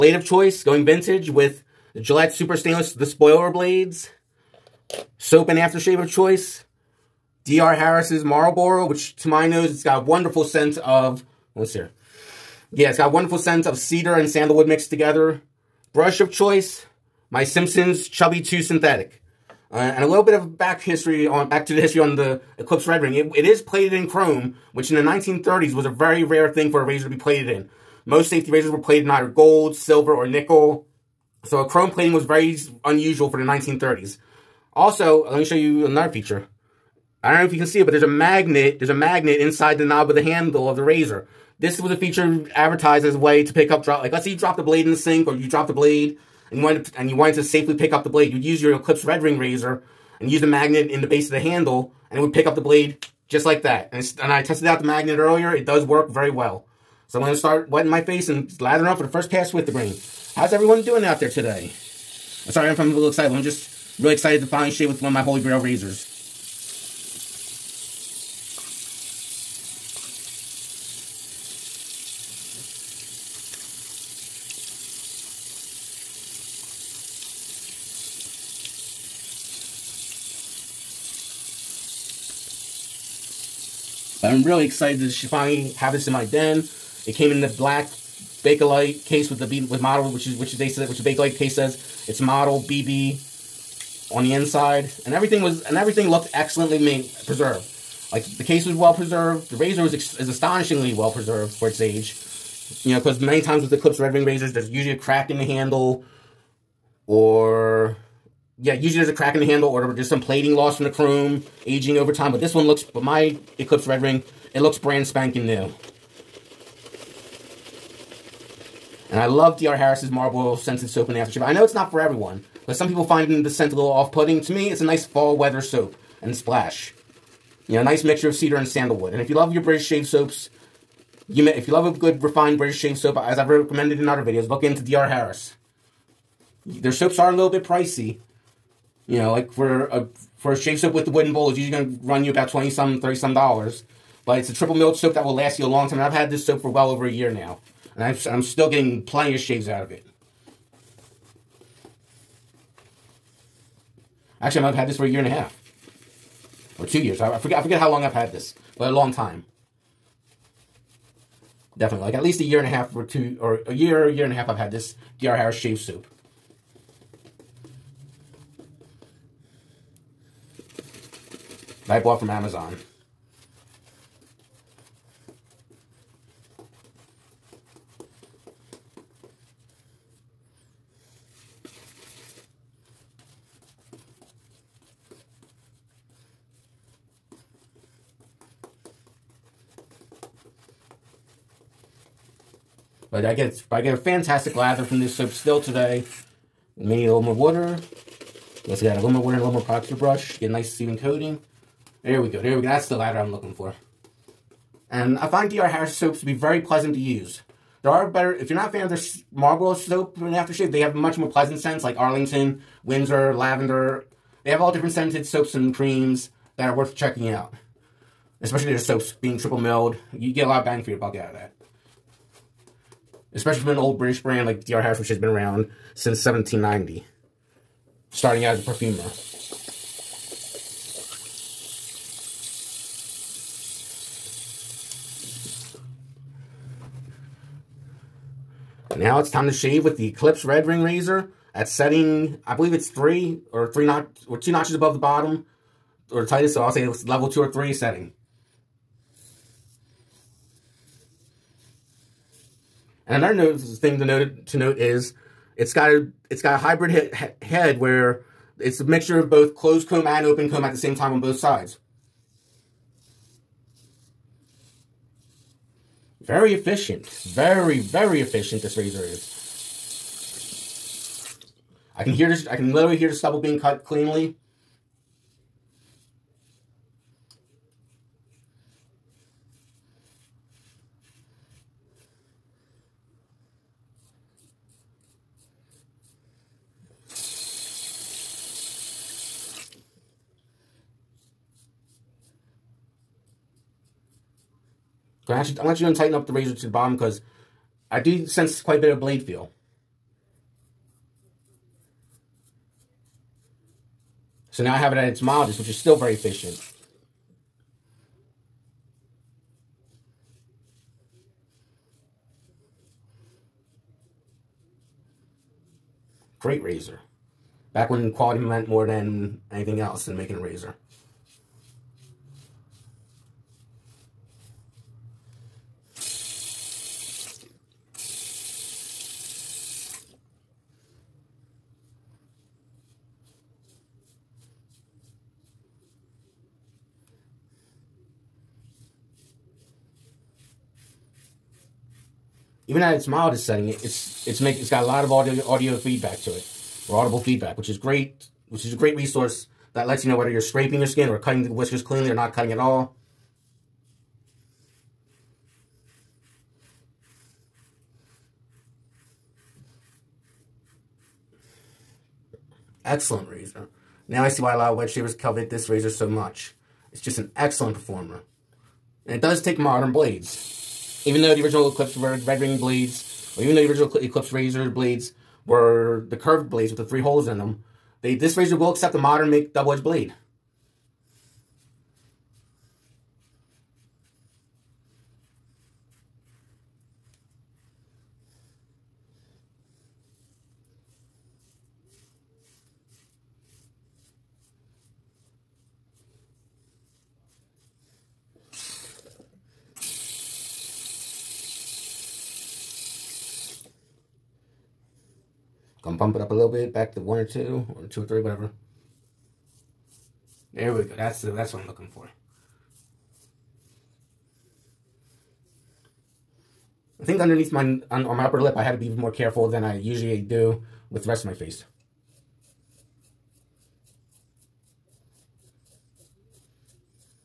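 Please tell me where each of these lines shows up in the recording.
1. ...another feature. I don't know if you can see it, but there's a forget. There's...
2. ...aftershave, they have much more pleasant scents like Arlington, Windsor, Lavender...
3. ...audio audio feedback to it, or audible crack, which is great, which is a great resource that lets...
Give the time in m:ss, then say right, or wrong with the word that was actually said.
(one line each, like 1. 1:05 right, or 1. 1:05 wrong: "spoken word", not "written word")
1. 0:35 wrong: "magnet", not "forget"
2. 3:30 right
3. 5:45 wrong: "feedback", not "crack".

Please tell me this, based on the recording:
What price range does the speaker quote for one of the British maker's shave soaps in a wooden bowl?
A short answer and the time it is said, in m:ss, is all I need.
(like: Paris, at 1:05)
$20 to $30, at 2:22.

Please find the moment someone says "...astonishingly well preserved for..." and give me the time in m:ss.
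1:40.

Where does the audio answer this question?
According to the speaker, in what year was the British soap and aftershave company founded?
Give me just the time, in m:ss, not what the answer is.
3:46.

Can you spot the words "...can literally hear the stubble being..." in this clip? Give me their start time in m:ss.
4:32.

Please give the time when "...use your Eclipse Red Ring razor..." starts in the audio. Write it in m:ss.
0:48.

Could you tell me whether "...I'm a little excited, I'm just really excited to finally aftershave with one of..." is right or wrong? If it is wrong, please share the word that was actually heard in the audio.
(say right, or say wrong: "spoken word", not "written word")
wrong: "shave", not "aftershave".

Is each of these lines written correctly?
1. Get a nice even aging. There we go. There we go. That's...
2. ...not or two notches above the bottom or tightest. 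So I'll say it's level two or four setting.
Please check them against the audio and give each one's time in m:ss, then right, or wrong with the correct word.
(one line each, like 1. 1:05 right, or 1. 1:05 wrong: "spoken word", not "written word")
1. 3:20 wrong: "coating", not "aging"
2. 4:03 wrong: "three", not "four".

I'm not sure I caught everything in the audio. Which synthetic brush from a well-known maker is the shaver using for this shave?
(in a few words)
Simpsons Chubby 2 Synthetic.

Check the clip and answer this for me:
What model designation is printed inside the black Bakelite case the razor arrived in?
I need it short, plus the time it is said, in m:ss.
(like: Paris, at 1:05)
BB, at 1:32.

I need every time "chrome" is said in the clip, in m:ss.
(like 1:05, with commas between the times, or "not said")
0:24, 0:31, 1:50.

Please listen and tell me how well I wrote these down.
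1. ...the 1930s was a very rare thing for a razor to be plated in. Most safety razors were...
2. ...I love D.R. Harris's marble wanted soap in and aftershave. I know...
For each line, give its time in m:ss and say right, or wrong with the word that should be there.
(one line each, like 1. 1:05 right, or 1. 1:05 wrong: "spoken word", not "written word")
1. 0:24 right
2. 1:59 wrong: "scented", not "wanted".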